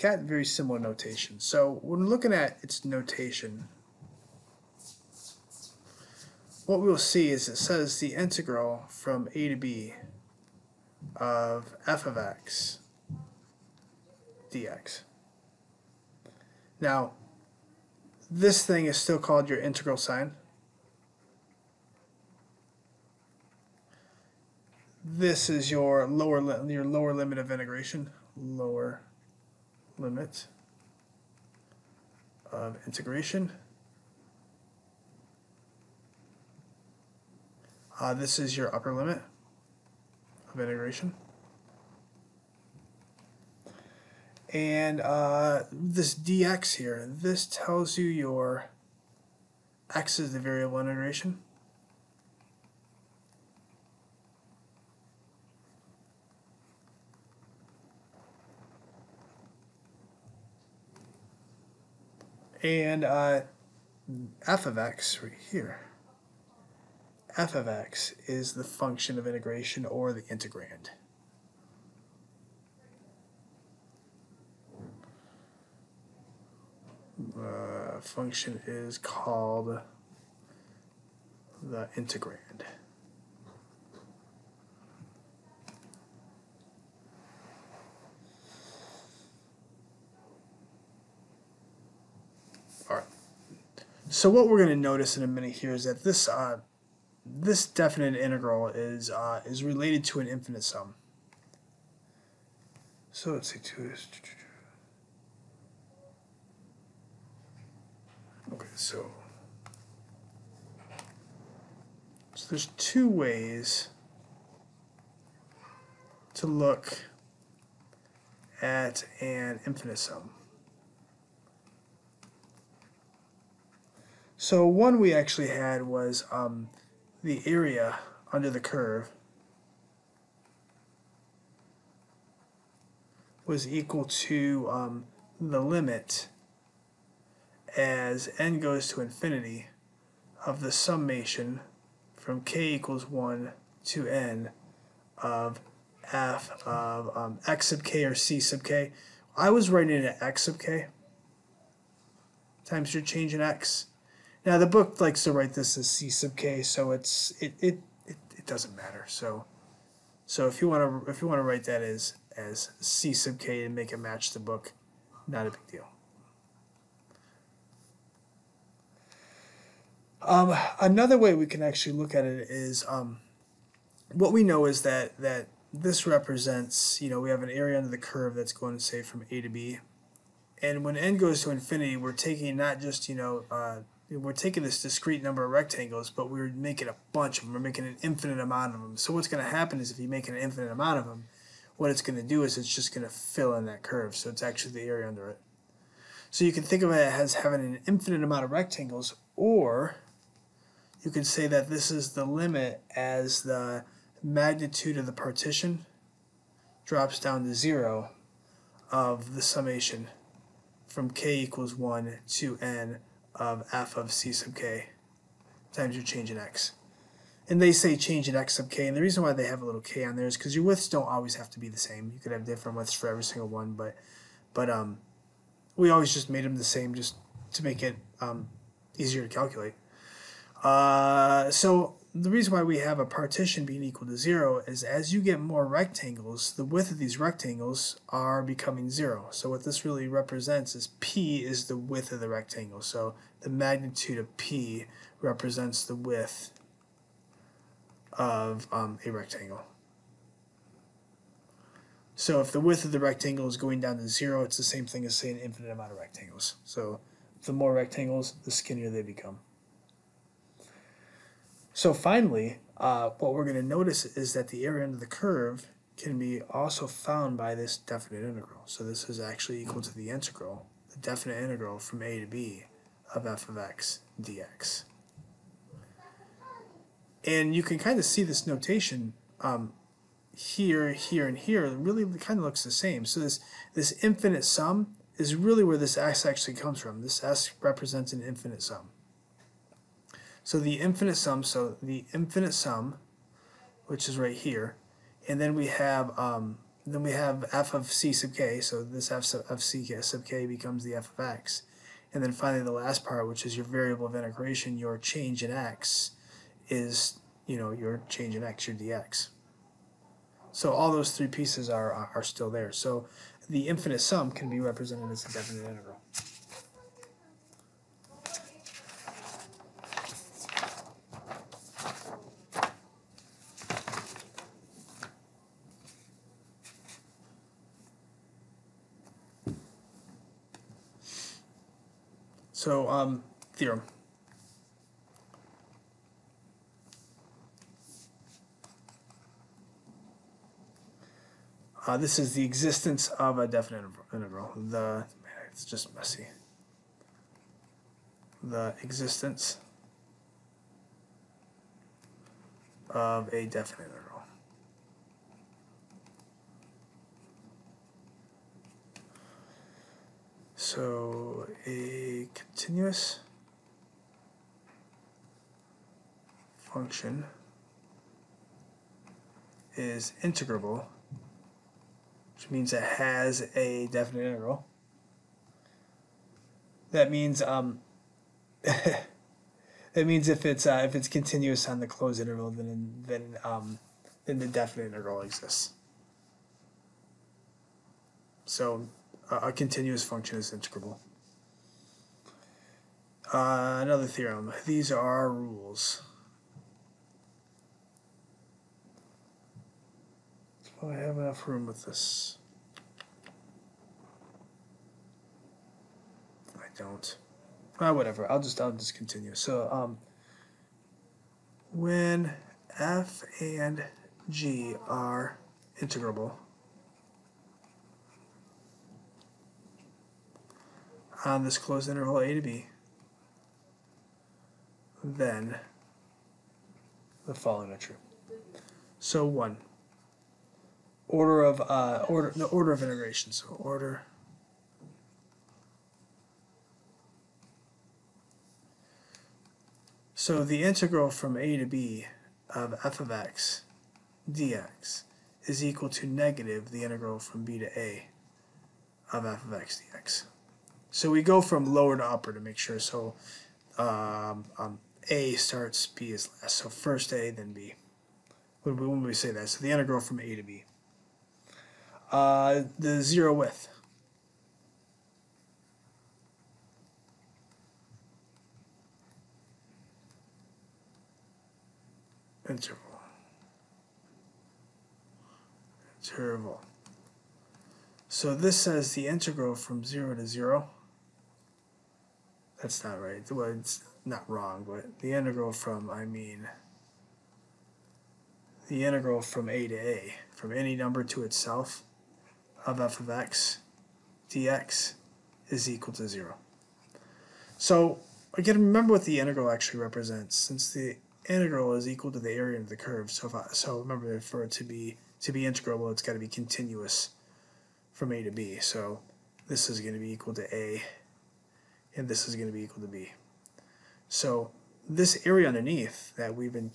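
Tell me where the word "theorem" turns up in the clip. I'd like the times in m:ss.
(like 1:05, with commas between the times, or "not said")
5:33, 6:34.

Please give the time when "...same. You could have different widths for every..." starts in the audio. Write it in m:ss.
3:41.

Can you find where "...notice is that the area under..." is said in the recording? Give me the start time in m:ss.
4:23.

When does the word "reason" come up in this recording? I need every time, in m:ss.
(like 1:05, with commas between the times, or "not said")
3:38, 3:52.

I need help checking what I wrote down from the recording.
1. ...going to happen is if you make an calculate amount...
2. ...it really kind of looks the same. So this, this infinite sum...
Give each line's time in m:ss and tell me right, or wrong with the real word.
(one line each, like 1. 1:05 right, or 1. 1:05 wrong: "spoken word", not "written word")
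1. 3:09 wrong: "infinite", not "calculate"
2. 4:41 right.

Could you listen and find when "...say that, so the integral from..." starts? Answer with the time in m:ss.
7:39.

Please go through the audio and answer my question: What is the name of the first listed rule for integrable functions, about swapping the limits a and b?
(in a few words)
order of integration.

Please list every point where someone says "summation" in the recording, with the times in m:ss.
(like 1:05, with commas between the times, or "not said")
2:20, 3:29.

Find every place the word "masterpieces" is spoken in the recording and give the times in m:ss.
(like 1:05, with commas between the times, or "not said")
not said.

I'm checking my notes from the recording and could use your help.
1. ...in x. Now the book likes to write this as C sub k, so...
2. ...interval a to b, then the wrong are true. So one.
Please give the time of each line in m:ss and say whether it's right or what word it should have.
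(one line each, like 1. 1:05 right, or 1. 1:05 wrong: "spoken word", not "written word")
1. 2:33 right
2. 7:01 wrong: "following", not "wrong".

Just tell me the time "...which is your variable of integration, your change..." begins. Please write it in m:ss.
5:03.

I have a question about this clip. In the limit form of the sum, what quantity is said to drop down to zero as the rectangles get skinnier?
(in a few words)
magnitude of the partition.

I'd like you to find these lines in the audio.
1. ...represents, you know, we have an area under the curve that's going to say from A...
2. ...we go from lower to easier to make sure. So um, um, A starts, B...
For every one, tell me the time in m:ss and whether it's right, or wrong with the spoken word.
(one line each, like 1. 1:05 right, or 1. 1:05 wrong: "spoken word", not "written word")
1. 2:56 right
2. 7:31 wrong: "upper", not "easier".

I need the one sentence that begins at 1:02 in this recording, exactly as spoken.
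And uh, f of x right here f of x is the function of integration or the integrand.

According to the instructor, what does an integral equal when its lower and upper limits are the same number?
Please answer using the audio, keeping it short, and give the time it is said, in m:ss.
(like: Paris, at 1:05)
0, at 8:15.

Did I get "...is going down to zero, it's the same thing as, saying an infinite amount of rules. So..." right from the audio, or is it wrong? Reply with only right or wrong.
wrong.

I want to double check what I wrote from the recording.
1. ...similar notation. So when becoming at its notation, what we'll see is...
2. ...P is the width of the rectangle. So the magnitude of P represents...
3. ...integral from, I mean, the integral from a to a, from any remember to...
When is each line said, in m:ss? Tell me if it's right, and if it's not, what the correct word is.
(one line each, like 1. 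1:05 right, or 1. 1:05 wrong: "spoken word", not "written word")
1. 0:00 wrong: "looking", not "becoming"
2. 4:00 right
3. 8:05 wrong: "number", not "remember".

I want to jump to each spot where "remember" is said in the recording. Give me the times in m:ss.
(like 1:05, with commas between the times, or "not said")
8:18, 8:23.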